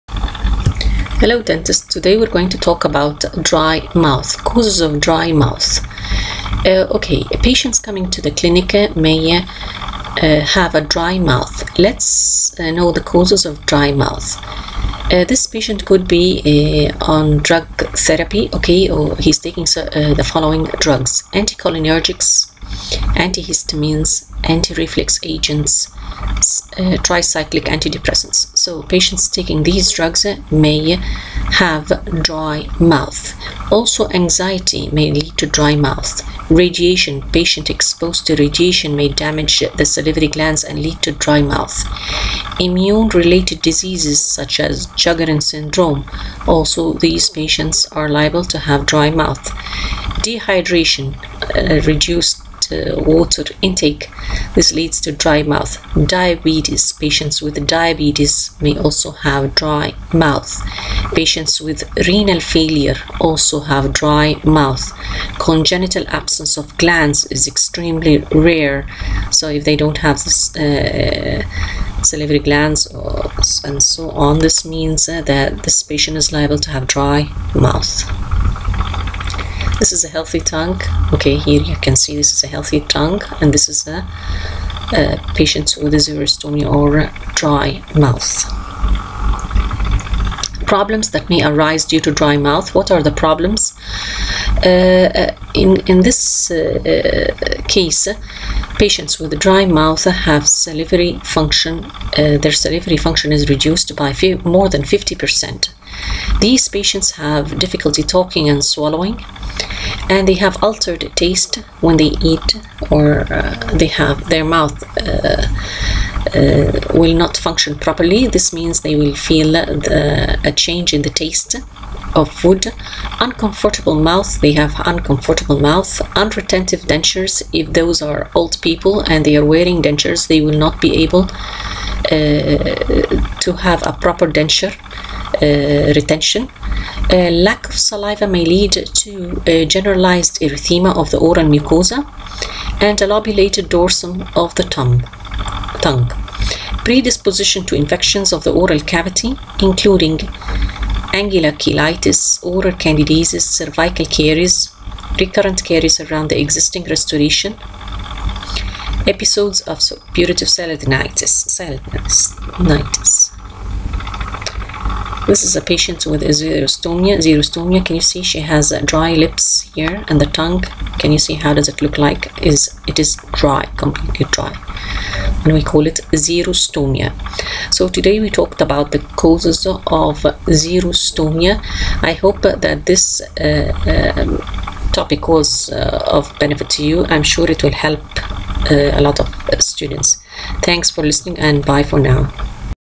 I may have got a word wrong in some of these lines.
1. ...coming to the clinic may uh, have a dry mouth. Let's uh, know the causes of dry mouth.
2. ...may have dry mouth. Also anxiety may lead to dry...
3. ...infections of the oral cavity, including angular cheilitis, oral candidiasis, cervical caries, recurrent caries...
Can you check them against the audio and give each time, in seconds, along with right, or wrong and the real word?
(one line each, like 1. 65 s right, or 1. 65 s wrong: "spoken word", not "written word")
1. 7 s right
2. 30 s right
3. 147 s right.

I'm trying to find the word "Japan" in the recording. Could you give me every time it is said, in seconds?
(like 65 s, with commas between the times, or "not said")
not said.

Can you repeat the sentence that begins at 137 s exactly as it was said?
Uh, lack of saliva may lead to uh, generalized erythema of the oral mucosa and a lobulated dorsum of the tongue.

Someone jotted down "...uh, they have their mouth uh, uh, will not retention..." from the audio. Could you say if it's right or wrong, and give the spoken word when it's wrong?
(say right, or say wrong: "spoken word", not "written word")
wrong: "function", not "retention".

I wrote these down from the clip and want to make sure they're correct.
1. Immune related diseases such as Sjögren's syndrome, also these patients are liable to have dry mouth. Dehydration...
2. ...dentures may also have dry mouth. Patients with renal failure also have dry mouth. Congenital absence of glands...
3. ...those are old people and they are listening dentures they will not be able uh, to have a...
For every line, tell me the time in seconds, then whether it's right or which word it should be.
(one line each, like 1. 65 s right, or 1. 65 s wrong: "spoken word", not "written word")
1. 42 s right
2. 57 s wrong: "diabetes", not "dentures"
3. 127 s wrong: "wearing", not "listening".